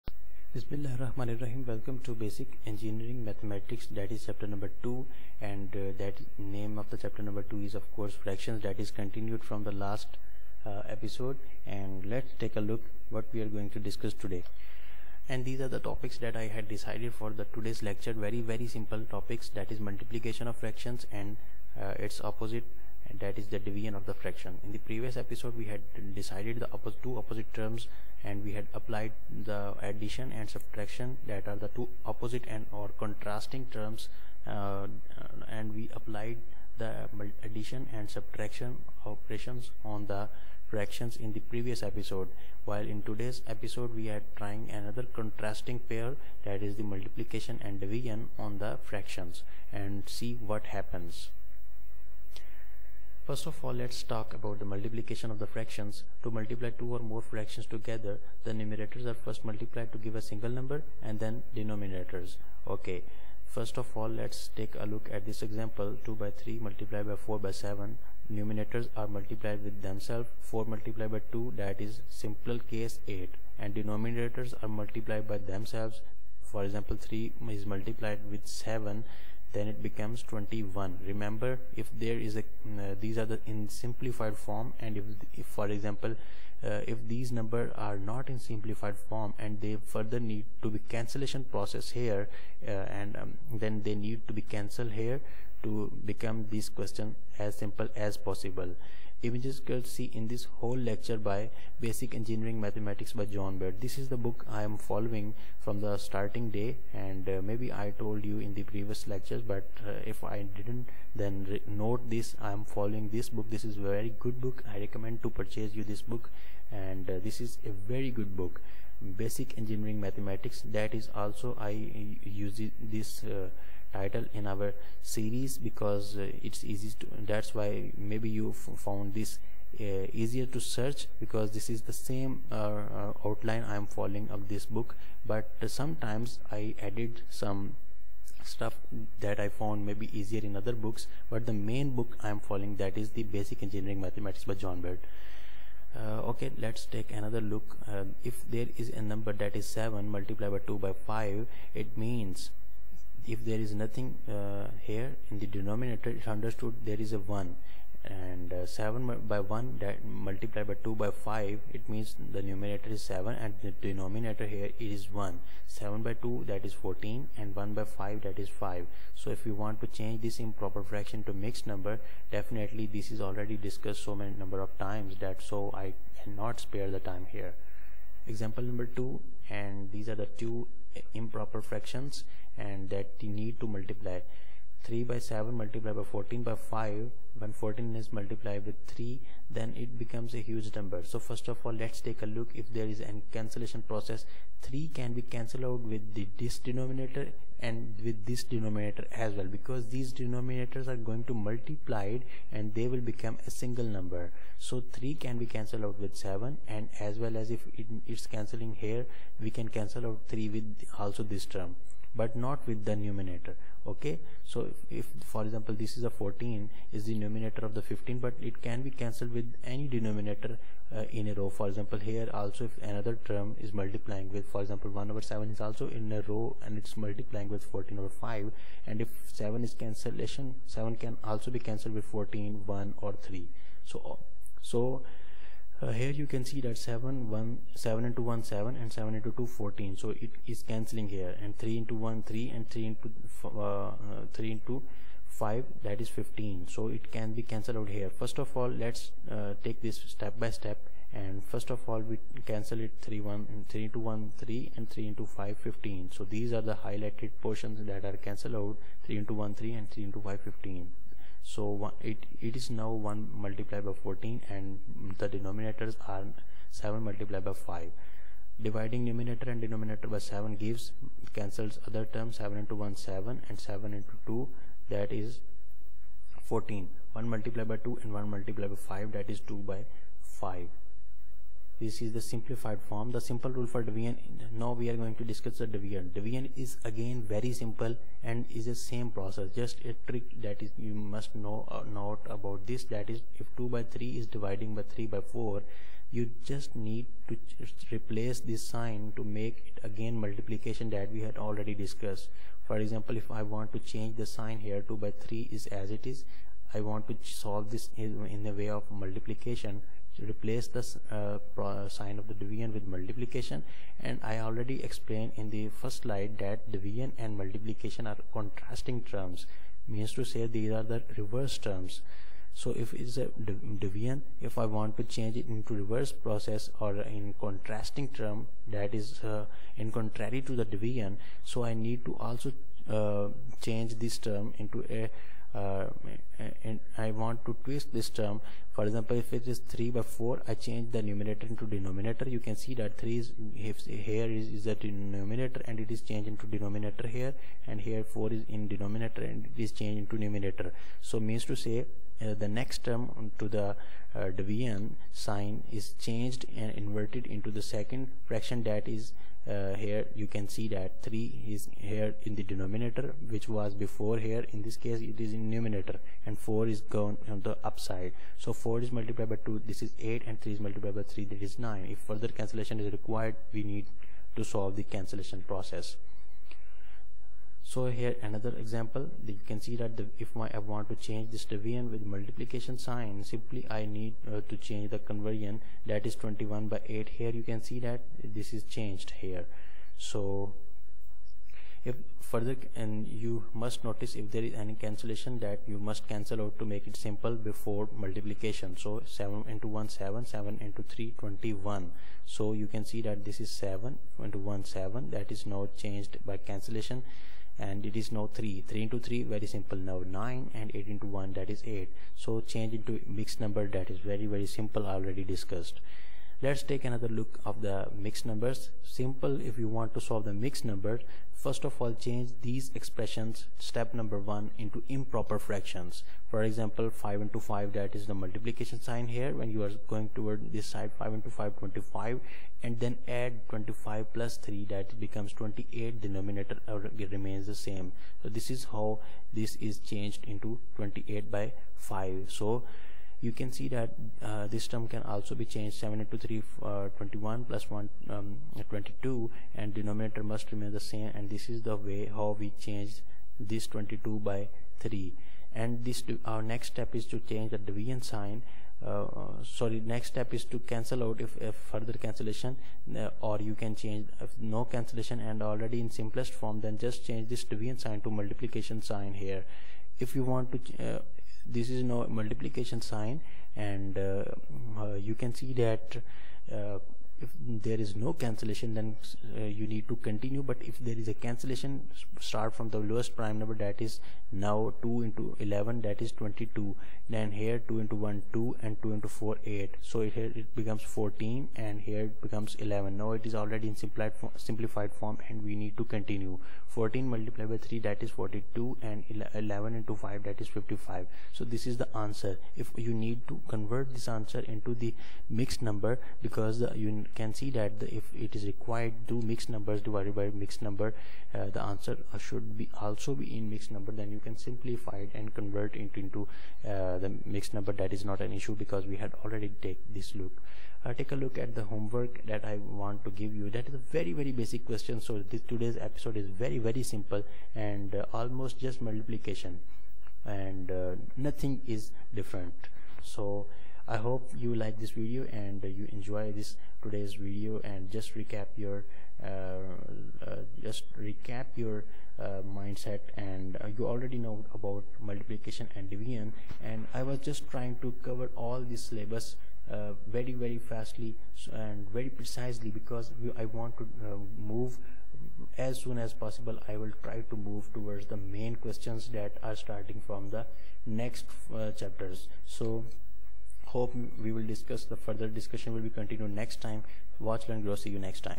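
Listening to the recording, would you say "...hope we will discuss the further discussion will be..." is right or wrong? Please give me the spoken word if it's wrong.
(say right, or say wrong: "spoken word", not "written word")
right.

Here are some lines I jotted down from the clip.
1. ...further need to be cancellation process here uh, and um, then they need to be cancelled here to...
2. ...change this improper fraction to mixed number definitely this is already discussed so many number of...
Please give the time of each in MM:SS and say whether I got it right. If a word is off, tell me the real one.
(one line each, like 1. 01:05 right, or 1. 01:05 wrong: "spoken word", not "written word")
1. 01:29 right
2. 02:49 right.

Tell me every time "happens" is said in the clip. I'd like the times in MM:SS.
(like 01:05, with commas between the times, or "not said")
00:50.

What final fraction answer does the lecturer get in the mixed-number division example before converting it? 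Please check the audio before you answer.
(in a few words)
42/55.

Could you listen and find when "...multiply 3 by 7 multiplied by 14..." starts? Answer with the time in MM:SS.
03:03.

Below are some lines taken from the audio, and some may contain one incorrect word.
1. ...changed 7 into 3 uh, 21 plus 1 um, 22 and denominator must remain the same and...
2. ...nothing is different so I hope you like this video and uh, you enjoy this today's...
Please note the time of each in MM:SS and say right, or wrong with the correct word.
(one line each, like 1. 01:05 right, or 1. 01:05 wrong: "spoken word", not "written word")
1. 07:25 right
2. 08:51 right.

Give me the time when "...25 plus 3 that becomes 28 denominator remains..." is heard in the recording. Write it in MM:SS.
07:13.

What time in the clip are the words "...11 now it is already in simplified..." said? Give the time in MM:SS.
08:12.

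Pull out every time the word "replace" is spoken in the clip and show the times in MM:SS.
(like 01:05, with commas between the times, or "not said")
04:57, 05:10.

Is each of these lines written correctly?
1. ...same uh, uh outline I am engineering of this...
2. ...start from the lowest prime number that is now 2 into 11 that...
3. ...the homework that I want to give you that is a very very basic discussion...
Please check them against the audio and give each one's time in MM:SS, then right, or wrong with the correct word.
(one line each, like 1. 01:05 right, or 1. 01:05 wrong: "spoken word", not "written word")
1. 02:11 wrong: "following", not "engineering"
2. 08:02 right
3. 08:41 wrong: "question", not "discussion".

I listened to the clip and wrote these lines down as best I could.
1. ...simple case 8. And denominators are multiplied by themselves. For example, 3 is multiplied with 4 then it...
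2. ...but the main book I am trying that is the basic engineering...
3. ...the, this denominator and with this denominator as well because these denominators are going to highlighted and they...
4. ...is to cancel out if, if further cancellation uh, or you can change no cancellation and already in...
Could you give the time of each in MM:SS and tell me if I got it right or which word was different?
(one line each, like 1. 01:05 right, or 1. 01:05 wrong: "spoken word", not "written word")
1. 01:12 wrong: "7", not "4"
2. 02:21 wrong: "following", not "trying"
3. 03:16 wrong: "multiplied", not "highlighted"
4. 07:40 right.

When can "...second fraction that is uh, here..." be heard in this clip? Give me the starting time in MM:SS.
05:57.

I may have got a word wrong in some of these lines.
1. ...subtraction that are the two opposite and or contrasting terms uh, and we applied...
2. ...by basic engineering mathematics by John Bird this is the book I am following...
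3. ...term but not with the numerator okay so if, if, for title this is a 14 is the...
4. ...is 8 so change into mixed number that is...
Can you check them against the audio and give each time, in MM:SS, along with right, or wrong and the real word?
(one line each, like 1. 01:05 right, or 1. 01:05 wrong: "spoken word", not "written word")
1. 00:30 right
2. 01:41 right
3. 03:31 wrong: "example", not "title"
4. 06:51 right.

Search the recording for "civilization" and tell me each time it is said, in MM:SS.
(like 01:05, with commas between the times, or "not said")
not said.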